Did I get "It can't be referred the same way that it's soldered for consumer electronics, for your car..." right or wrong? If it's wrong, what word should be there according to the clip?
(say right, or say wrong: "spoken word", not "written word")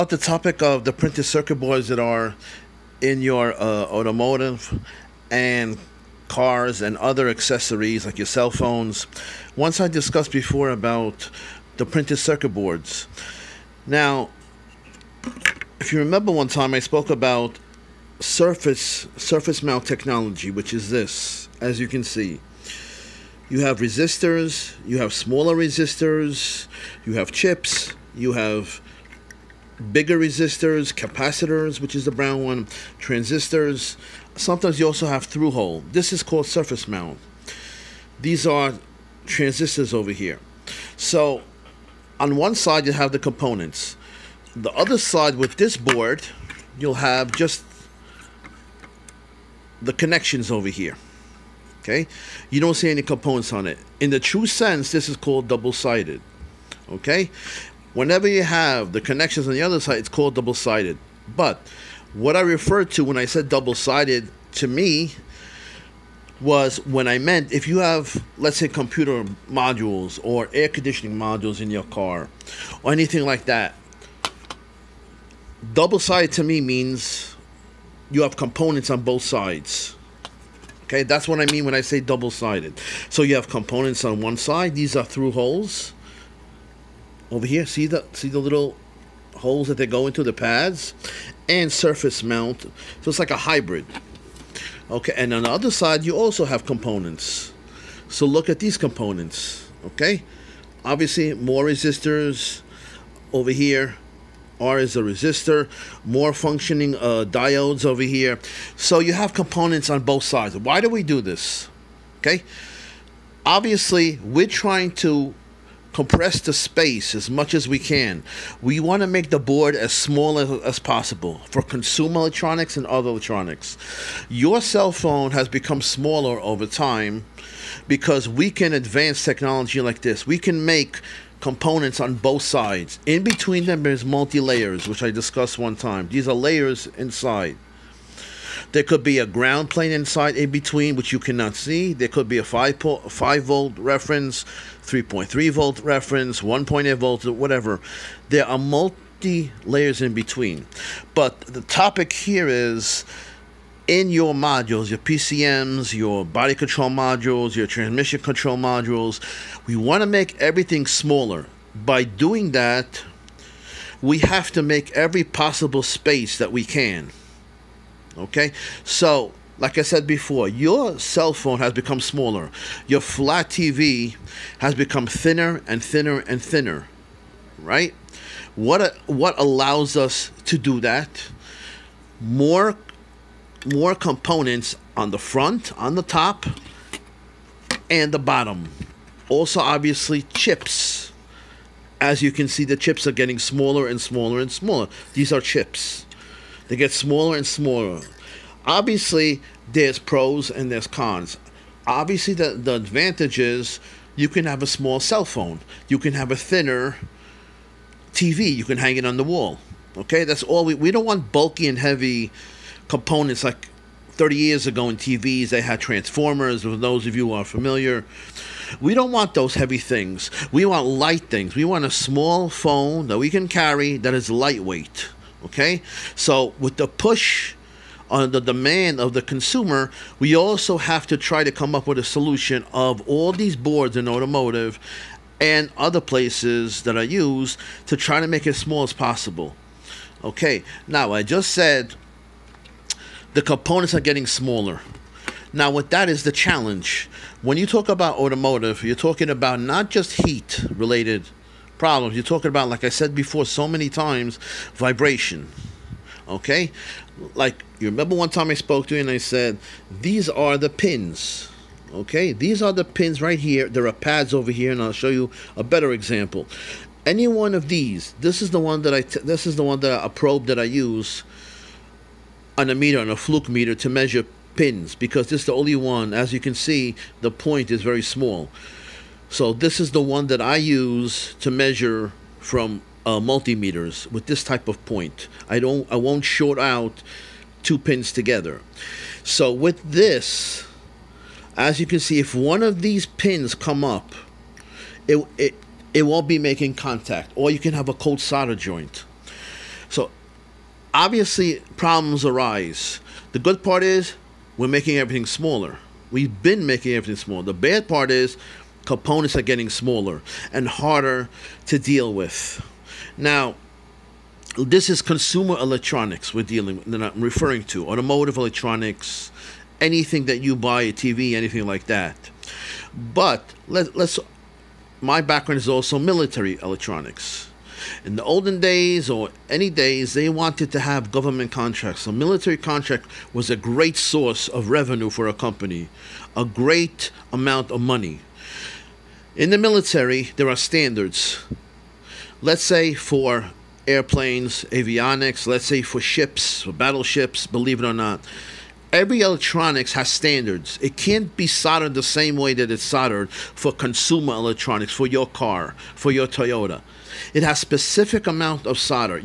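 wrong: "soldered", not "referred".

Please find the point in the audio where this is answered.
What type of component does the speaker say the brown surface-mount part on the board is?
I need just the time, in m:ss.
0:30.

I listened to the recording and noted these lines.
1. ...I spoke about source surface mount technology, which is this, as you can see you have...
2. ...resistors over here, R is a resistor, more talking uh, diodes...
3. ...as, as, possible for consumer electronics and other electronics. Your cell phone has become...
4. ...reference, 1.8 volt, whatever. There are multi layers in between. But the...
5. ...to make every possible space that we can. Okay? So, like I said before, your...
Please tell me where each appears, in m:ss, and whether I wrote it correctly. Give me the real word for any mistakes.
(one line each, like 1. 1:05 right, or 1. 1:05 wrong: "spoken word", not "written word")
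1. 0:16 wrong: "surface", not "source"
2. 1:41 wrong: "functioning", not "talking"
3. 2:00 right
4. 2:25 right
5. 2:44 right.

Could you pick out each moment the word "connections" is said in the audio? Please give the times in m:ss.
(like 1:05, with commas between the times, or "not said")
0:49, 0:59.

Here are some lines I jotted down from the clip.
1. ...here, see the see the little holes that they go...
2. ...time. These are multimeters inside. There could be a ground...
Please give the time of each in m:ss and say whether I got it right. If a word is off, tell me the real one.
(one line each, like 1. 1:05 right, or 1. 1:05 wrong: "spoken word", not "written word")
1. 1:27 right
2. 2:15 wrong: "layers", not "multimeters".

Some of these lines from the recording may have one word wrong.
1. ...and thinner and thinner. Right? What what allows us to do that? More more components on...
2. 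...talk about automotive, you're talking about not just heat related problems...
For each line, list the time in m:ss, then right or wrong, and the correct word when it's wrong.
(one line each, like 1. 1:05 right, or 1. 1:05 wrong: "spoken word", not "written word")
1. 2:55 right
2. 4:07 right.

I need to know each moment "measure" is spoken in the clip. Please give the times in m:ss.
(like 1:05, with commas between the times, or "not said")
4:33, 4:41.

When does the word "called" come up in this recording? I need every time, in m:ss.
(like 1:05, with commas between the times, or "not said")
0:36, 0:55, 1:00.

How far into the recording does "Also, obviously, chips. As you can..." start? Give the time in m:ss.
3:09.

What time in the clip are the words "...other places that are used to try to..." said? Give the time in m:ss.
3:55.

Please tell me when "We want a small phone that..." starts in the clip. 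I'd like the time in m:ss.
3:41.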